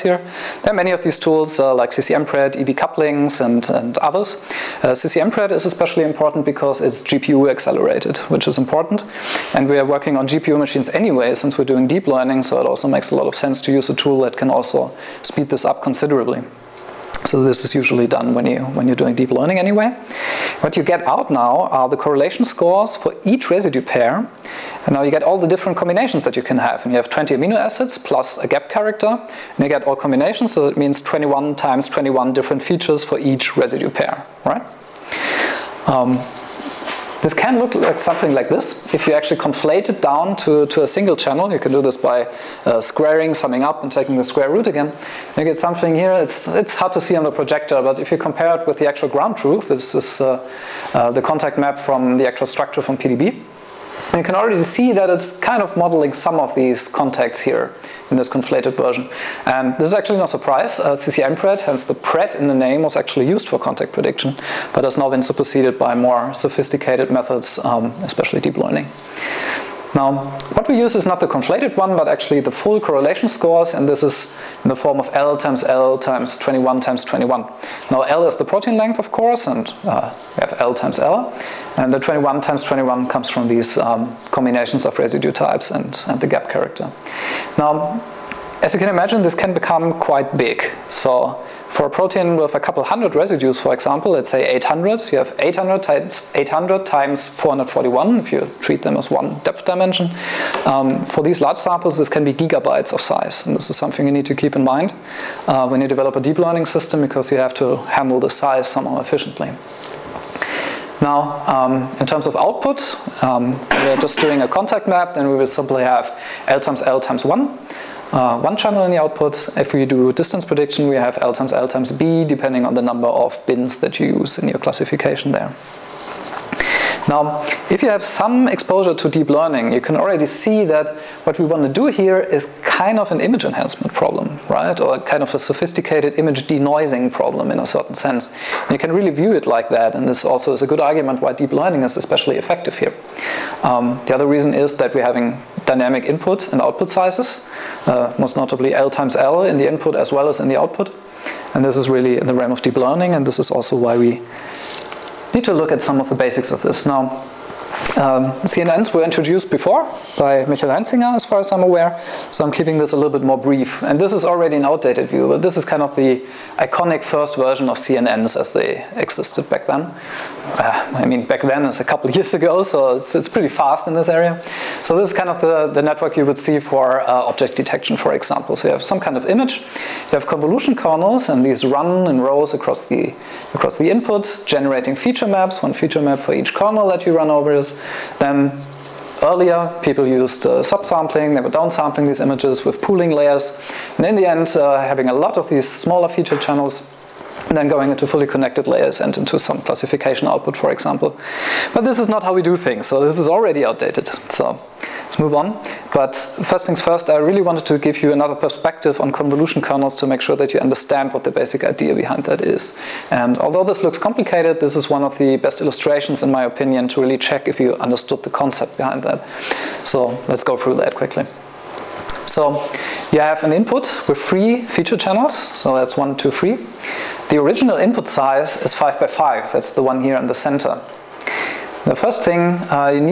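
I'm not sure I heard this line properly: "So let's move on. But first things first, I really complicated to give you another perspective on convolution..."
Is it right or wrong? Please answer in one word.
wrong.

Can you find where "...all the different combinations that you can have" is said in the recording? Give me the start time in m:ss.
0:25.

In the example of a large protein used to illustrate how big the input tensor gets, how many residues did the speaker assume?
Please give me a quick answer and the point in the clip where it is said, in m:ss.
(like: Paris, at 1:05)
800, at 1:34.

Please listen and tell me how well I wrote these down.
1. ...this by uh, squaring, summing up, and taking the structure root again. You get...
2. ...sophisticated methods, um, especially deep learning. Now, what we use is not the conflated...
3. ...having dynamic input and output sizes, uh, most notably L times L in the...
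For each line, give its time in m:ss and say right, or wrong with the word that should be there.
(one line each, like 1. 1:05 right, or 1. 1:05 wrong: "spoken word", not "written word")
1. 0:41 wrong: "square", not "structure"
2. 1:06 right
3. 2:25 right.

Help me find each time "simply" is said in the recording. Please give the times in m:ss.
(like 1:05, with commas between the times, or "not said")
1:55.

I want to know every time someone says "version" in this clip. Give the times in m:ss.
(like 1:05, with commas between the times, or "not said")
0:58, 2:47.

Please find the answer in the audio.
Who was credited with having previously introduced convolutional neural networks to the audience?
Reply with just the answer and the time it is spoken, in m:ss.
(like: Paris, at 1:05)
Michael Heinzinger, at 2:40.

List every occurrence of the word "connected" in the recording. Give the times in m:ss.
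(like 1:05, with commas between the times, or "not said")
3:18.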